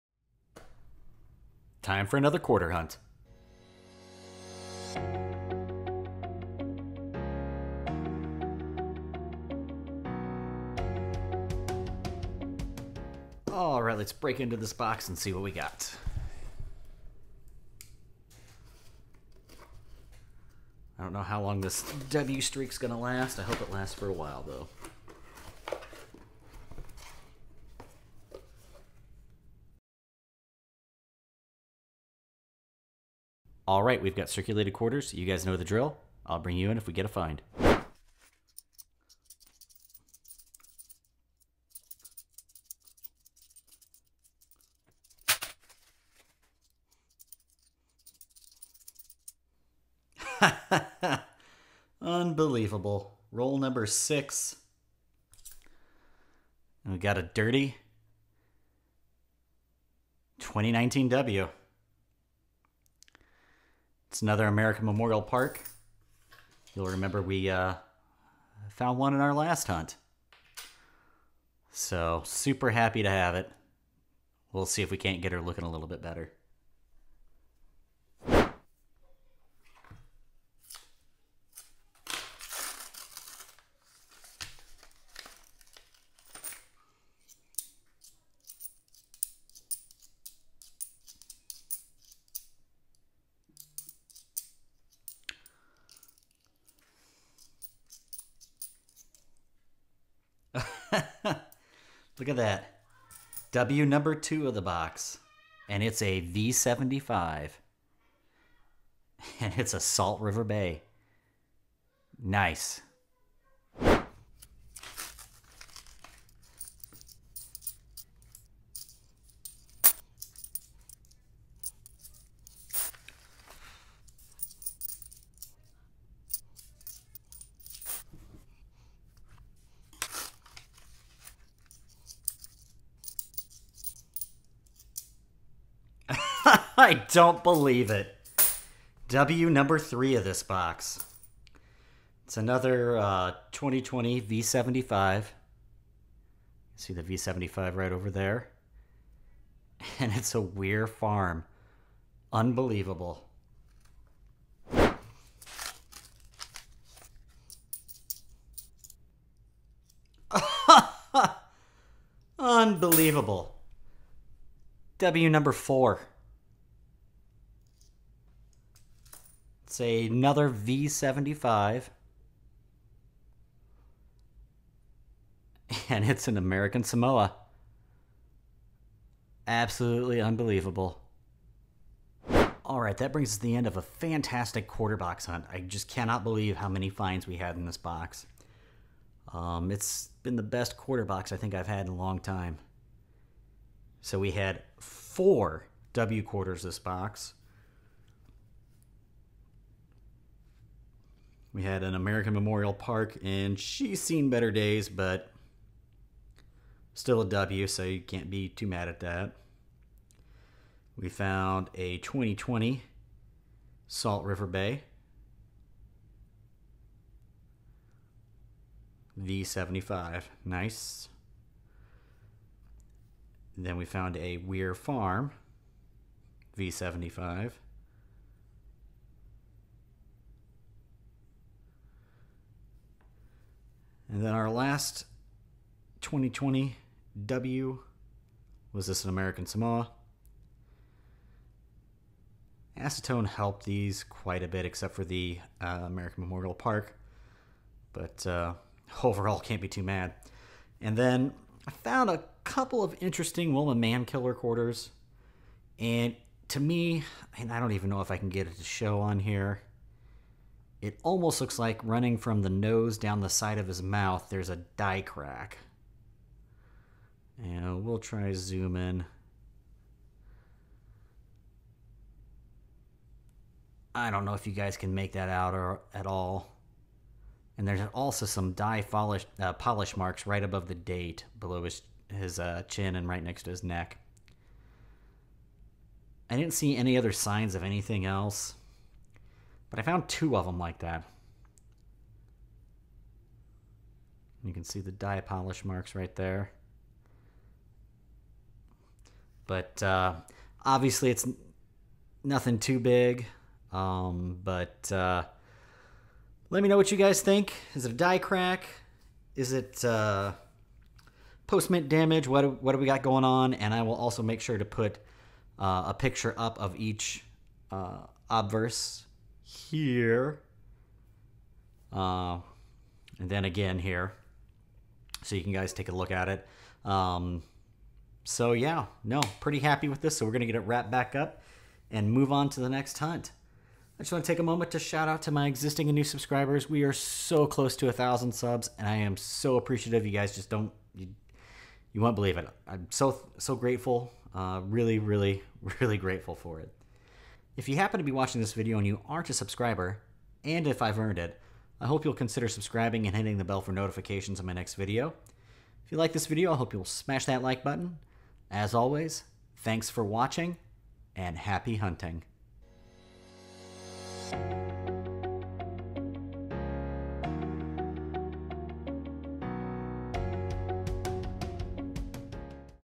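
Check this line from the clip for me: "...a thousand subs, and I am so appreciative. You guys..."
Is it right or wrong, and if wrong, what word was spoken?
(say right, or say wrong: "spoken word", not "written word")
right.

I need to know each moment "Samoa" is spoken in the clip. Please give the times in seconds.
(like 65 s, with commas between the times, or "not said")
176 s, 239 s.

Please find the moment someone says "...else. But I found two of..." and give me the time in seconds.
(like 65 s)
288 s.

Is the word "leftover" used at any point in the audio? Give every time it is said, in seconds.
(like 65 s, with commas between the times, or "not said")
not said.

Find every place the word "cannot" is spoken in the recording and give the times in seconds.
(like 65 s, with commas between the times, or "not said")
185 s.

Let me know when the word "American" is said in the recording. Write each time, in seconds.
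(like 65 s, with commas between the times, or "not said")
64 s, 176 s, 201 s, 239 s, 245 s.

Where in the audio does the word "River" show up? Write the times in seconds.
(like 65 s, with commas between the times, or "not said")
110 s, 214 s.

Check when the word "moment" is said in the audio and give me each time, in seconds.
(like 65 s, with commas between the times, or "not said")
334 s.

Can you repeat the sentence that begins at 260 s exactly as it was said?
It almost looks like running from the nose down the side of his mouth, there's a die crack.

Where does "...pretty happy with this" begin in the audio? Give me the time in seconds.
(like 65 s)
329 s.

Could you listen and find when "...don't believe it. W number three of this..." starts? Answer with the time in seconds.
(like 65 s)
137 s.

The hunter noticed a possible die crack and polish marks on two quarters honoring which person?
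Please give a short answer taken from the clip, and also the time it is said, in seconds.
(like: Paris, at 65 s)
Wilma Mankiller, at 253 s.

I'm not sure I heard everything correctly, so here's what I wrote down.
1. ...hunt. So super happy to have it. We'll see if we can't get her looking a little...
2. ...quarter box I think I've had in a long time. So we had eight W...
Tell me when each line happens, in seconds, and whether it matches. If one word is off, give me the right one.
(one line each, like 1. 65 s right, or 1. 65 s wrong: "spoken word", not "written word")
1. 69 s right
2. 190 s wrong: "four", not "eight".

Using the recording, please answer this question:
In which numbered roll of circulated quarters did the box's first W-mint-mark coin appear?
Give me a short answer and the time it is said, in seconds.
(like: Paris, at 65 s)
6, at 53 s.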